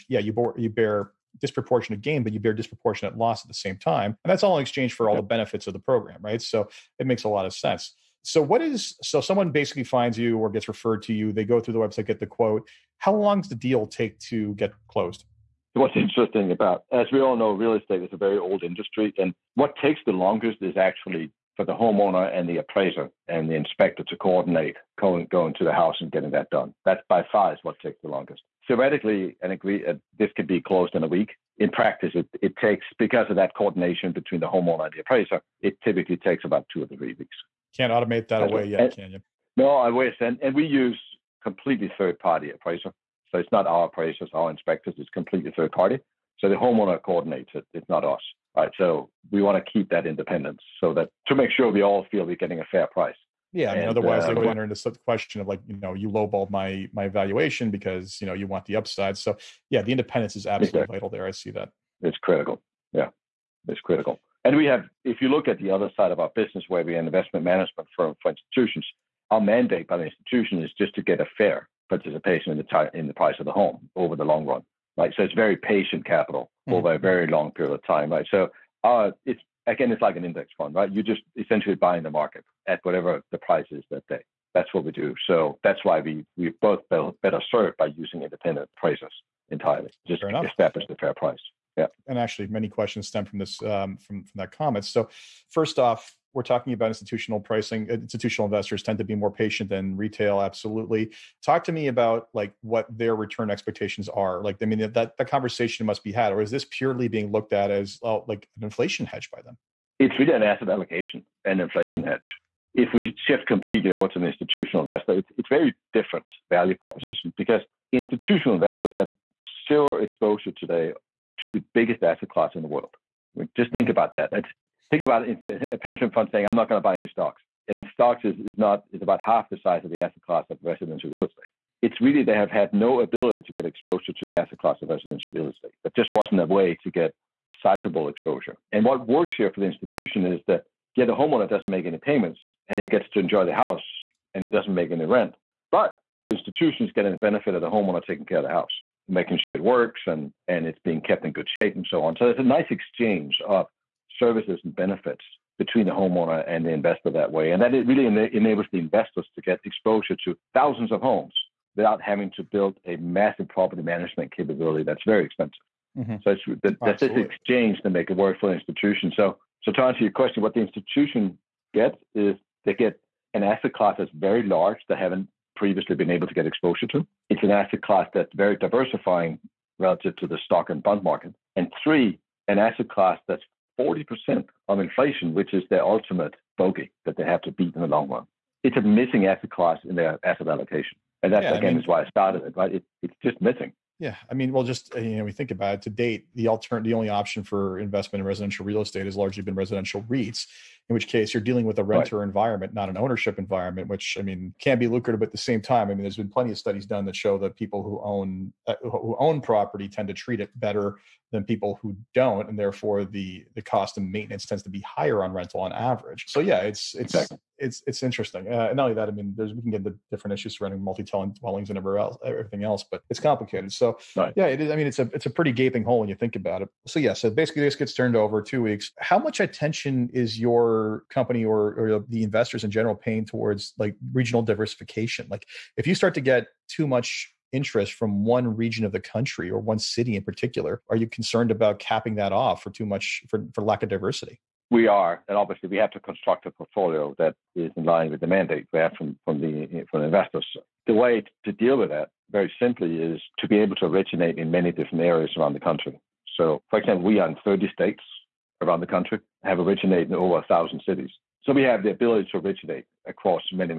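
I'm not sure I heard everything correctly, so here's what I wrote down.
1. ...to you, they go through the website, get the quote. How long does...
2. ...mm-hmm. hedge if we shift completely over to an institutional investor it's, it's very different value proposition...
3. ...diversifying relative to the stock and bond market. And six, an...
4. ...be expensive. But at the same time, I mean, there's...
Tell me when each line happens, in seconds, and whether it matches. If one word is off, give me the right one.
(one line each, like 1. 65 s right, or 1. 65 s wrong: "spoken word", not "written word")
1. 11 s right
2. 112 s right
3. 178 s wrong: "three", not "six"
4. 204 s wrong: "lucrative", not "expensive".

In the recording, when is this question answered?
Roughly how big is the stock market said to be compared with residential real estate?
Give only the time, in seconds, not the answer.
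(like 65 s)
129 s.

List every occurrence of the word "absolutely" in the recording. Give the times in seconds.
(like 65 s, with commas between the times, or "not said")
60 s, 100 s.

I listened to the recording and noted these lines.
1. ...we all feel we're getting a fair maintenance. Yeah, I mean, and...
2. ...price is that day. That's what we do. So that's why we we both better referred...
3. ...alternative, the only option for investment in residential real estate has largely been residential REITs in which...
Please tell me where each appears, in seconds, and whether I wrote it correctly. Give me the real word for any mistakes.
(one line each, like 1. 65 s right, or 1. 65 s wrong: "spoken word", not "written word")
1. 51 s wrong: "price", not "maintenance"
2. 83 s wrong: "served", not "referred"
3. 196 s right.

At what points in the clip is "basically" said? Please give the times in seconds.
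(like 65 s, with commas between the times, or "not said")
9 s, 227 s.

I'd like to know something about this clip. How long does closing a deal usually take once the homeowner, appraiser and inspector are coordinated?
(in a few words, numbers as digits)
2 or 3 weeks.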